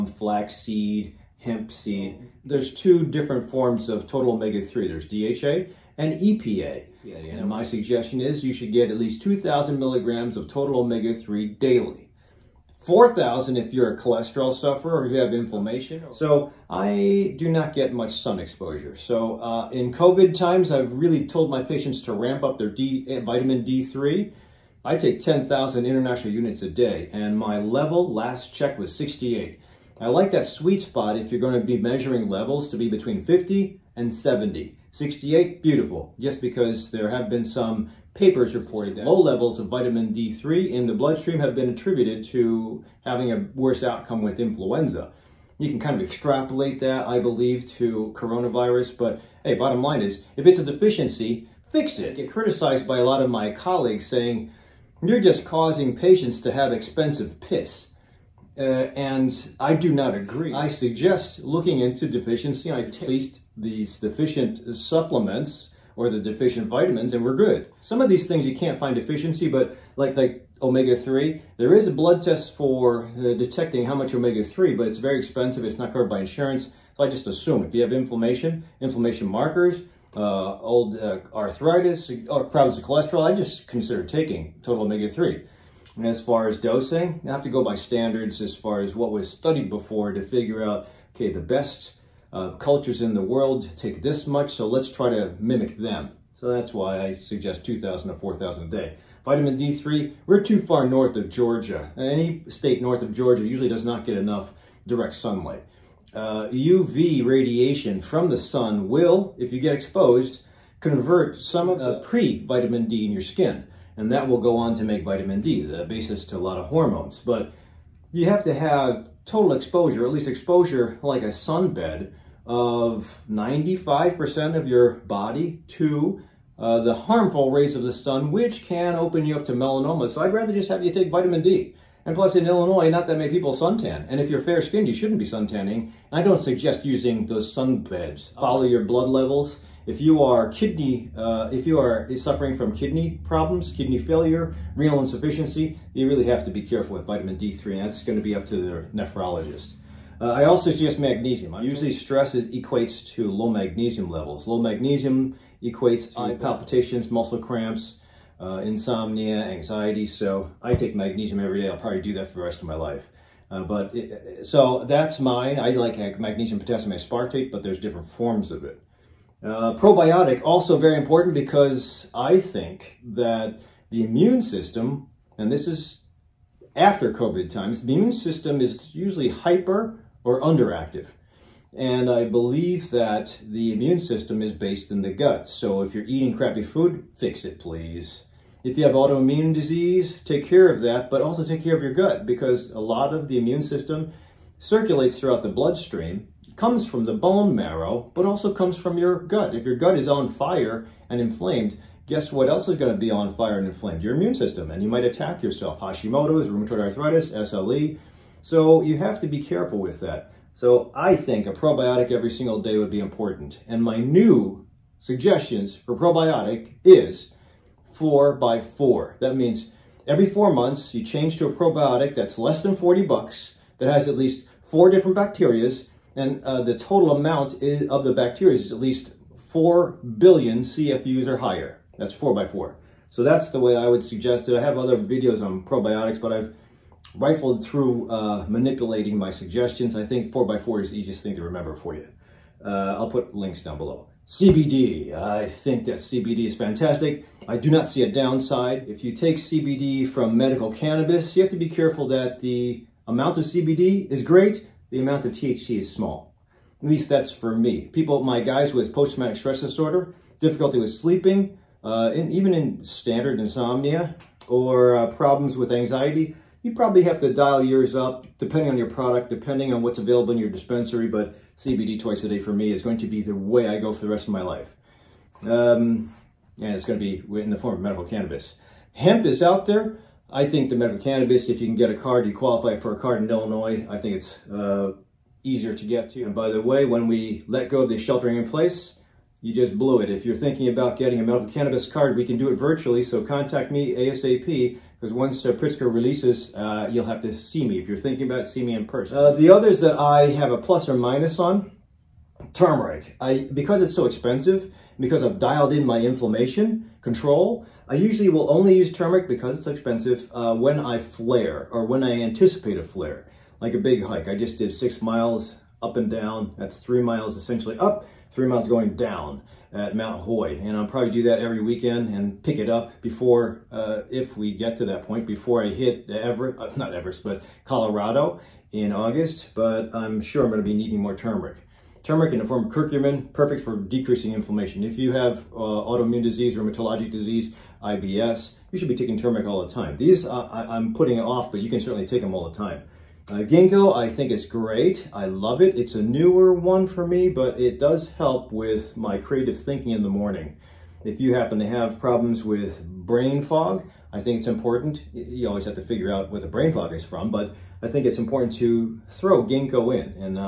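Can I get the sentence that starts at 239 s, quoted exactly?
I think 4x4 is the easiest thing to remember for you.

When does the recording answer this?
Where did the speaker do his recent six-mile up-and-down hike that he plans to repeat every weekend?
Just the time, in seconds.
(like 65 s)
319 s.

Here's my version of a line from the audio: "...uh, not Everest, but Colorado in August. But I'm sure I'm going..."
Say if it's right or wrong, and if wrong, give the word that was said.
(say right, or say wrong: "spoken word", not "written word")
right.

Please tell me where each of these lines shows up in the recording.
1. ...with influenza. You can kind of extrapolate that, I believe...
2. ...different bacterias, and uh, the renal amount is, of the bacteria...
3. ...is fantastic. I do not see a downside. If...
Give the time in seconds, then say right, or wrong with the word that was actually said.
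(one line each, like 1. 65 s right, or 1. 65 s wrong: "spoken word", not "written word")
1. 44 s right
2. 224 s wrong: "total", not "renal"
3. 246 s right.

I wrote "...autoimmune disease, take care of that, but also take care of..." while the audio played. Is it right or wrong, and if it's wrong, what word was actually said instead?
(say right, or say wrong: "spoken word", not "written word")
right.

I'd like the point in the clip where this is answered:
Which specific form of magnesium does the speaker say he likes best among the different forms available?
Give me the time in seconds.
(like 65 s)
166 s.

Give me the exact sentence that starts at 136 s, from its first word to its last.
I don't suggest using those sunbeds.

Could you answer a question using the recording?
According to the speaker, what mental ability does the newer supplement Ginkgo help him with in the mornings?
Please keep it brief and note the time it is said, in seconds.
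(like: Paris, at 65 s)
creative thinking, at 349 s.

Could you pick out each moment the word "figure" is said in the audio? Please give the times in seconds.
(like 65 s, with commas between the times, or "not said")
90 s, 355 s.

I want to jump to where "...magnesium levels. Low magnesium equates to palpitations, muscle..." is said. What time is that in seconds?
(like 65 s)
153 s.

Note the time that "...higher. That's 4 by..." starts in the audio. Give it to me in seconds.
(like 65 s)
231 s.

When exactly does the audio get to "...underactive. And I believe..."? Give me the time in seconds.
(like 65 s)
180 s.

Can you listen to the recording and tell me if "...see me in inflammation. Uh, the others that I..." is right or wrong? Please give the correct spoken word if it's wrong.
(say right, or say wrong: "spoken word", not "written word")
wrong: "person", not "inflammation".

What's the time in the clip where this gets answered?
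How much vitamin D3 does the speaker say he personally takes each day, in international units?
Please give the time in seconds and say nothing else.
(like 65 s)
25 s.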